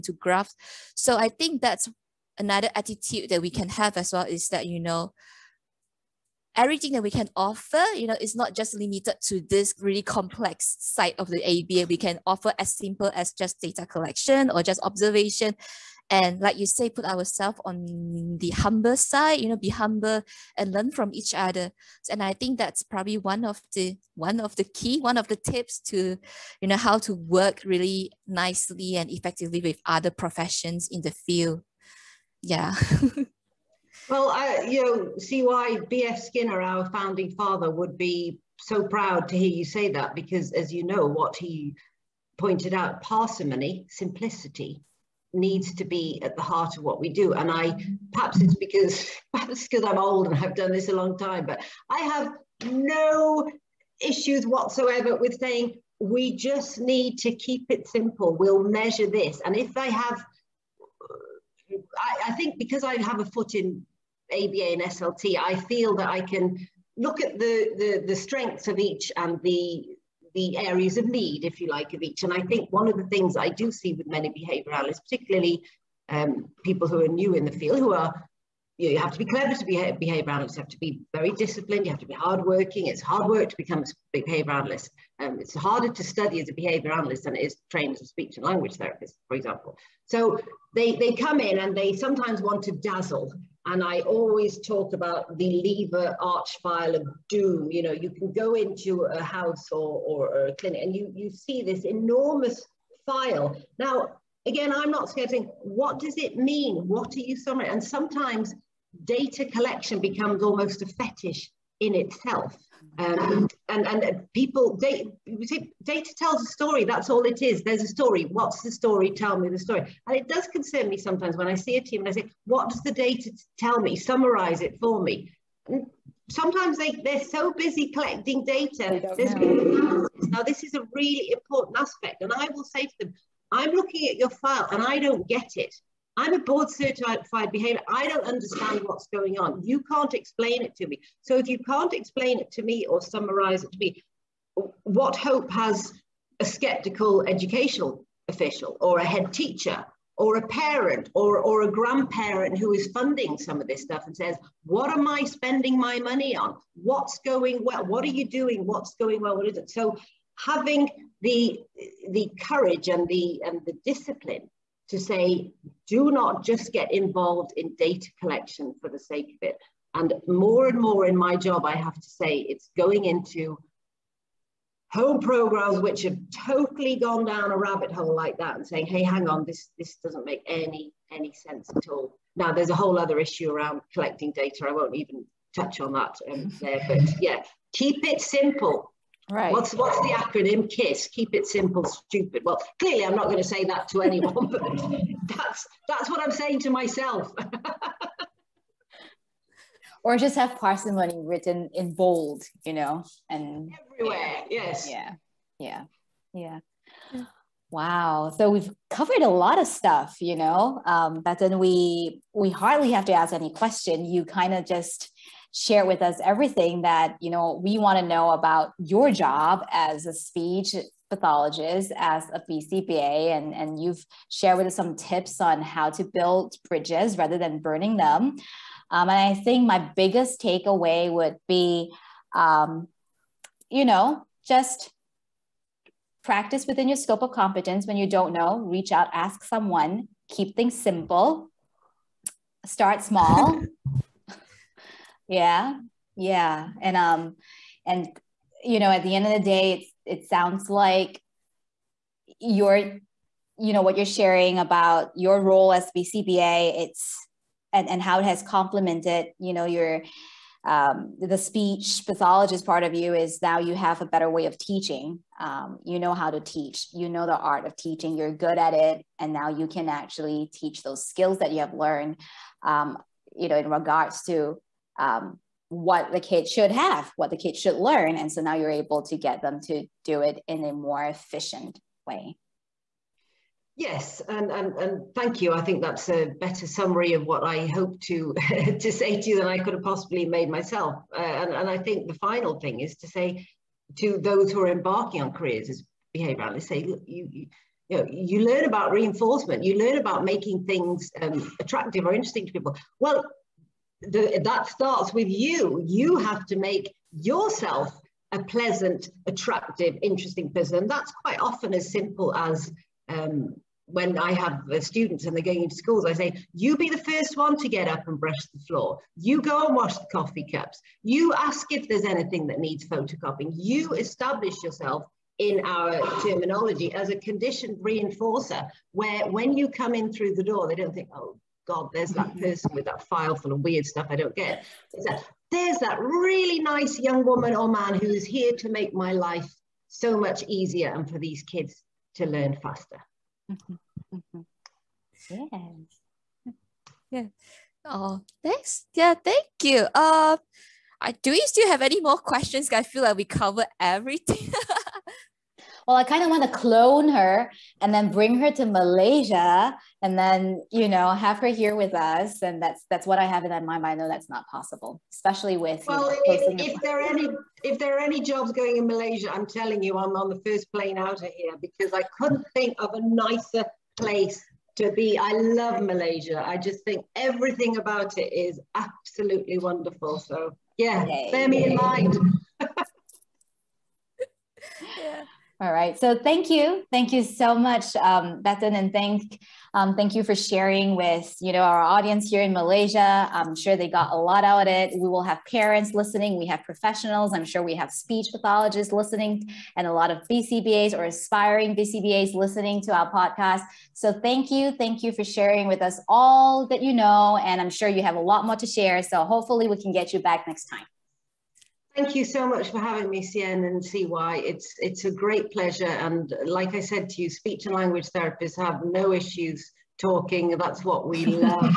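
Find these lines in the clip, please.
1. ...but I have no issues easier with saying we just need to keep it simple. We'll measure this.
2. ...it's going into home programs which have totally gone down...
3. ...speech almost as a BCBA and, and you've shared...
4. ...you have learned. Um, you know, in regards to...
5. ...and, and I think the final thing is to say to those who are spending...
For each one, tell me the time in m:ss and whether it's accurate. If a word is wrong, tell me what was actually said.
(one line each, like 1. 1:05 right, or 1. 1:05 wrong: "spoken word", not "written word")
1. 0:51 wrong: "whatsoever", not "easier"
2. 2:52 right
3. 3:40 wrong: "pathologist", not "almost"
4. 4:31 right
5. 4:51 wrong: "embarking", not "spending".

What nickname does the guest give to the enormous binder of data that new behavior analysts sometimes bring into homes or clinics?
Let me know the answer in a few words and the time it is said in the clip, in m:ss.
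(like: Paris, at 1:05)
Lever arch file of doom, at 1:35.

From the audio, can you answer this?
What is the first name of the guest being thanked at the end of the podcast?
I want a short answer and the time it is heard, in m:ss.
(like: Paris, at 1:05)
Bethan, at 6:28.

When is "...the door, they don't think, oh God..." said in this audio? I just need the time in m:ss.
5:30.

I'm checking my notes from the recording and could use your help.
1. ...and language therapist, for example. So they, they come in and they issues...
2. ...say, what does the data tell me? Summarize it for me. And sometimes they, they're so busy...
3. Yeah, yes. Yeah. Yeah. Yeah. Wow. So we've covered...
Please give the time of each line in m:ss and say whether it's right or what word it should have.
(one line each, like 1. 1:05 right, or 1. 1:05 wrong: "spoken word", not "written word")
1. 1:28 wrong: "sometimes", not "issues"
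2. 2:02 right
3. 3:24 right.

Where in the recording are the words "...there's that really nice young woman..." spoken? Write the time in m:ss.
5:35.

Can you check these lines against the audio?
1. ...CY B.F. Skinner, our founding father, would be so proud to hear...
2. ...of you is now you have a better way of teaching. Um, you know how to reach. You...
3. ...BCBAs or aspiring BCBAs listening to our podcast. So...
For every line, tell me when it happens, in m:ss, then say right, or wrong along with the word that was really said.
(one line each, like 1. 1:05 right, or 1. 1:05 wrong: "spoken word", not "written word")
1. 0:35 right
2. 4:22 wrong: "teach", not "reach"
3. 6:40 right.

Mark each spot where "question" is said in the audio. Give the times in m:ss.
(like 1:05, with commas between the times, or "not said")
3:33, 5:52.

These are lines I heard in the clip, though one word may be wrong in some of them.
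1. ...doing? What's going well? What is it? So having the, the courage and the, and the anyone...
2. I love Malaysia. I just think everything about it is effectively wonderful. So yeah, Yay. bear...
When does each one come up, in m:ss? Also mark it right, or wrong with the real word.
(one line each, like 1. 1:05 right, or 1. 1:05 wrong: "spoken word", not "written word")
1. 2:38 wrong: "discipline", not "anyone"
2. 6:15 wrong: "absolutely", not "effectively".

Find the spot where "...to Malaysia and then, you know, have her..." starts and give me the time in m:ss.
5:58.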